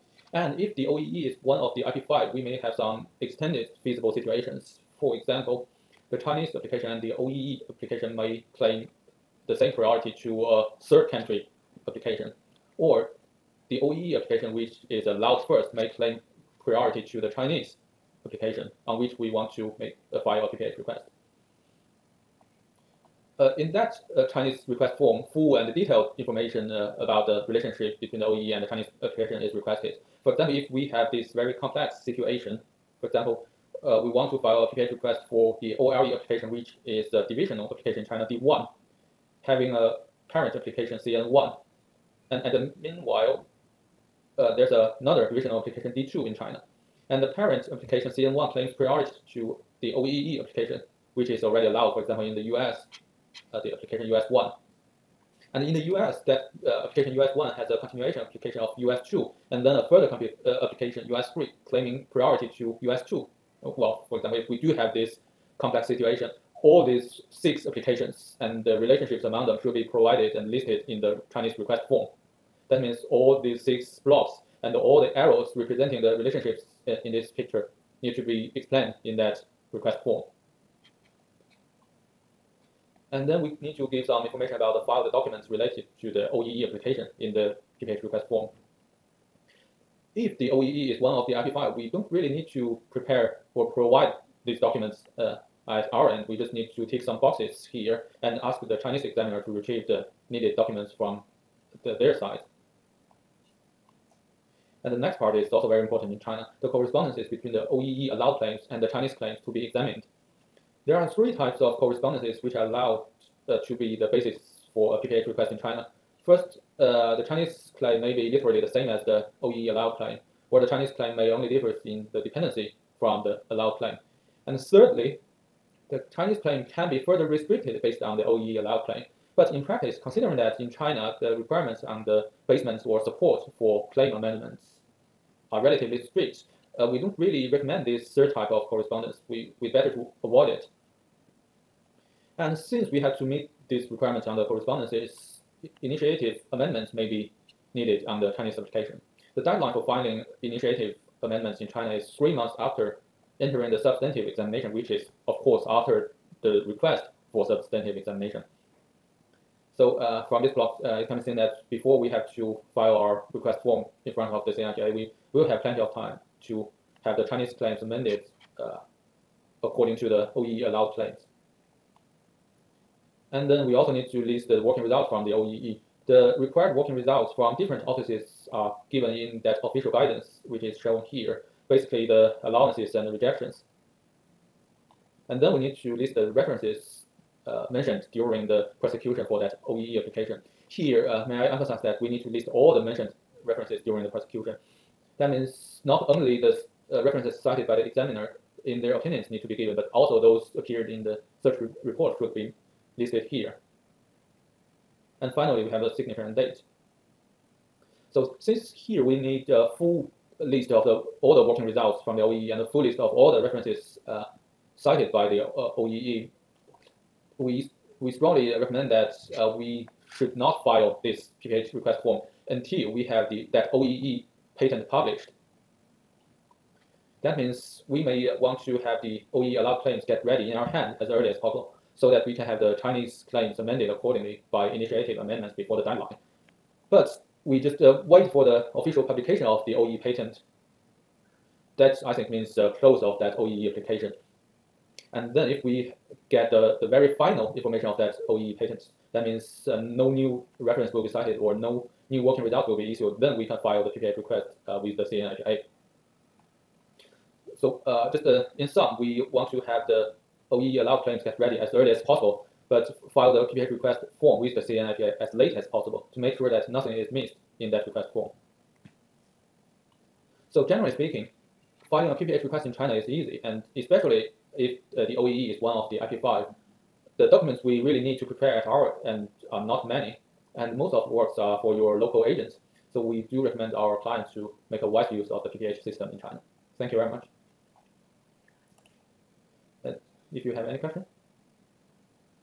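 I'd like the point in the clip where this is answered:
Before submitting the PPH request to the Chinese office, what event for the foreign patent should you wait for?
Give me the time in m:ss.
3:58.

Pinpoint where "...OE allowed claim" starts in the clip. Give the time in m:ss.
2:08.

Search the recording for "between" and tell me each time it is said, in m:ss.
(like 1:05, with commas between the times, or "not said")
0:28, 1:47.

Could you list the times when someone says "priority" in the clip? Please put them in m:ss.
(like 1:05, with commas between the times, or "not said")
0:09, 0:16, 0:48, 1:02.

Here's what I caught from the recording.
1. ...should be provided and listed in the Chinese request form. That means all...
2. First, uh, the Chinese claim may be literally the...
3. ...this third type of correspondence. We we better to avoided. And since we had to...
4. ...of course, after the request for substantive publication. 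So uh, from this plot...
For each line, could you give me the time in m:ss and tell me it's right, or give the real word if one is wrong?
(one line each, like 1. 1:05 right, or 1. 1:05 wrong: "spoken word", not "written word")
1. 1:09 right
2. 1:56 right
3. 2:17 right
4. 2:35 wrong: "examination", not "publication".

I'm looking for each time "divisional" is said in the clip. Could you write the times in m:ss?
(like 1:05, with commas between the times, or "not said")
0:37, 0:45.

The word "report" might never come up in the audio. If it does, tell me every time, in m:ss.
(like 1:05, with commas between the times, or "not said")
3:21.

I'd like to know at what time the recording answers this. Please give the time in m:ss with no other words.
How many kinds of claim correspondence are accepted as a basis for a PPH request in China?
1:51.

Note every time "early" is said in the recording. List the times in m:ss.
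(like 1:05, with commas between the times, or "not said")
3:51, 4:21.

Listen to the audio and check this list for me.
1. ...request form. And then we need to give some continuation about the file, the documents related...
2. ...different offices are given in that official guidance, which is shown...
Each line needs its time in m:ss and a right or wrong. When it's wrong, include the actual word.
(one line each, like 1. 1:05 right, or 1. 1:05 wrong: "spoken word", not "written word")
1. 1:19 wrong: "information", not "continuation"
2. 2:57 right.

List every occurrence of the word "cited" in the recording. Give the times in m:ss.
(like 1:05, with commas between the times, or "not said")
3:17, 3:34, 4:11.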